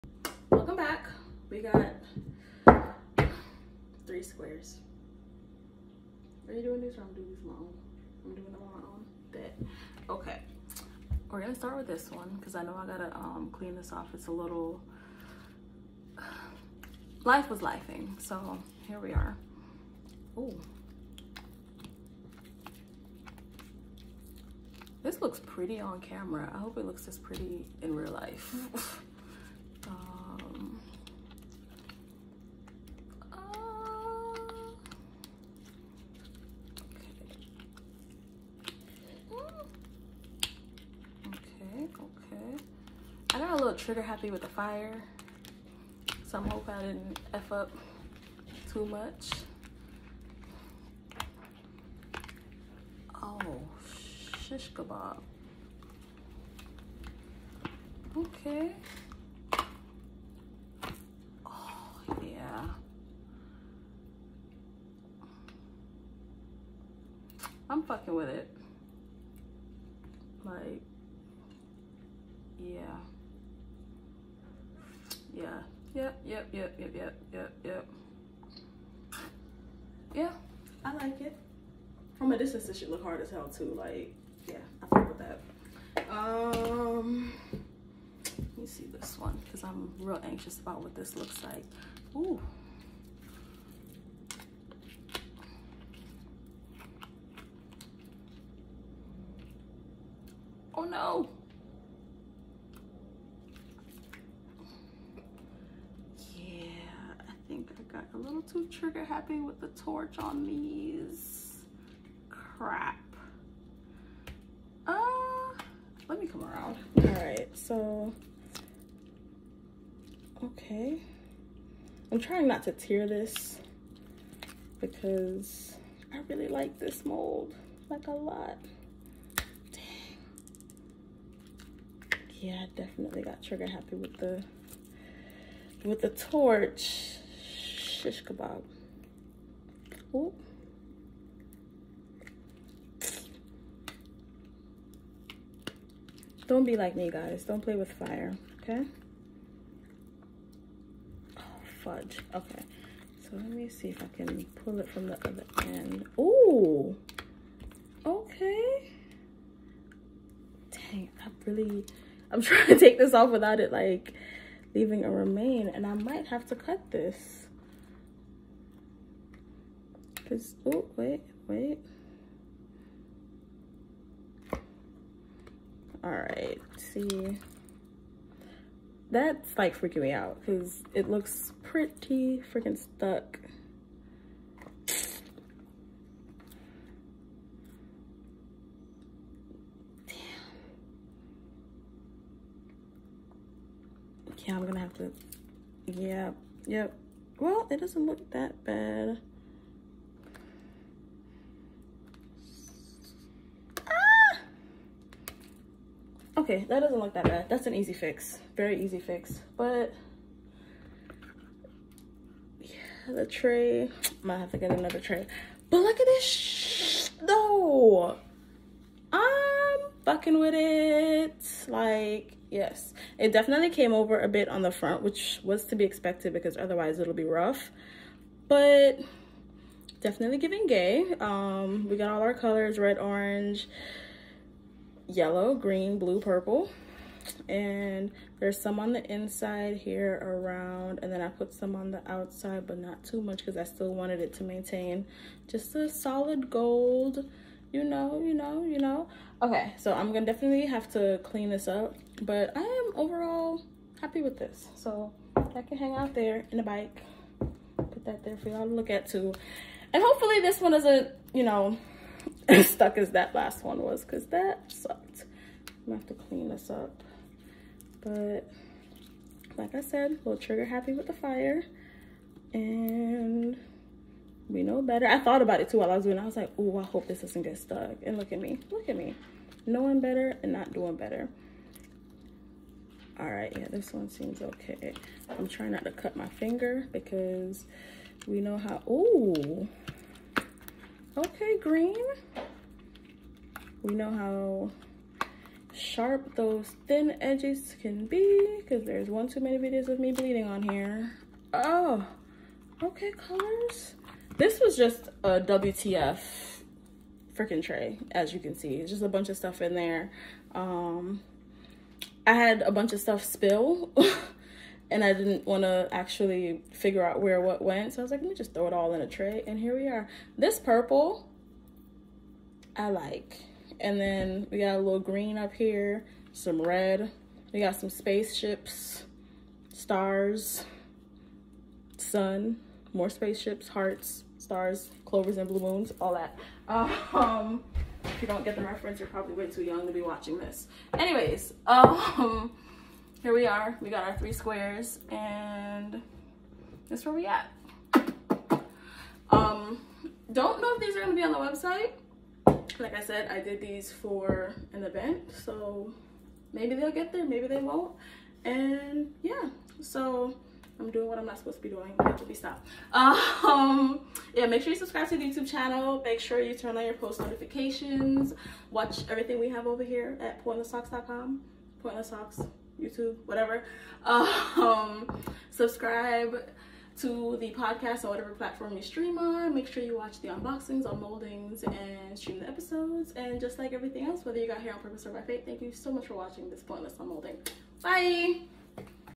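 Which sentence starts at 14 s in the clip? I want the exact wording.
It's a little life was lifing, so here we are.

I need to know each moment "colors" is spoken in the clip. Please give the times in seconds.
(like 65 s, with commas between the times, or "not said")
232 s, 303 s.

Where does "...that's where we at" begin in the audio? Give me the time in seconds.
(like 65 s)
346 s.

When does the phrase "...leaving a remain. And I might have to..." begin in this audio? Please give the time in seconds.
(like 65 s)
164 s.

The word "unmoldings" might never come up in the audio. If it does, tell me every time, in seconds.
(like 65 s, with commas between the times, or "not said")
380 s, 386 s.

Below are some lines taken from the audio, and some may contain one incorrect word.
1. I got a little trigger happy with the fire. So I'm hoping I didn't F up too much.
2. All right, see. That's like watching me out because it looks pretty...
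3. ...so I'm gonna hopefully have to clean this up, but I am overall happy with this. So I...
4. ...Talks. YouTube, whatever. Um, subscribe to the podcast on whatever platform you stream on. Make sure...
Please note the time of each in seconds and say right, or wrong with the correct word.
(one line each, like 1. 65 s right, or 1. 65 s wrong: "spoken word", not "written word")
1. 43 s right
2. 176 s wrong: "freaking", not "watching"
3. 249 s wrong: "definitely", not "hopefully"
4. 372 s right.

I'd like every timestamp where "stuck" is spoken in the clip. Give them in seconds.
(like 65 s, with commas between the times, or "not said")
182 s, 262 s, 277 s.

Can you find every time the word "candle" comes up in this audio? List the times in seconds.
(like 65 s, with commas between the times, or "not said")
not said.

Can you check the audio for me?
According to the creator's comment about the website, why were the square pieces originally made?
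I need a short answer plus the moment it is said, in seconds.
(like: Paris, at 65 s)
For an event, at 353 s.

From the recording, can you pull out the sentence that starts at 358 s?
And yeah, so I'm doing what I'm not supposed to be doing.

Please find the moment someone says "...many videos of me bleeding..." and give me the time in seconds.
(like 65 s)
299 s.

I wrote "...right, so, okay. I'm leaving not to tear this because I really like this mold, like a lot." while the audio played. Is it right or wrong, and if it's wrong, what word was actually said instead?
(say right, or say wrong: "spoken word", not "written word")
wrong: "trying", not "leaving".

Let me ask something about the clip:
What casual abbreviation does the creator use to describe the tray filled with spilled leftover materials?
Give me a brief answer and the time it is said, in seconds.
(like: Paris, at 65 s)
WTF, at 305 s.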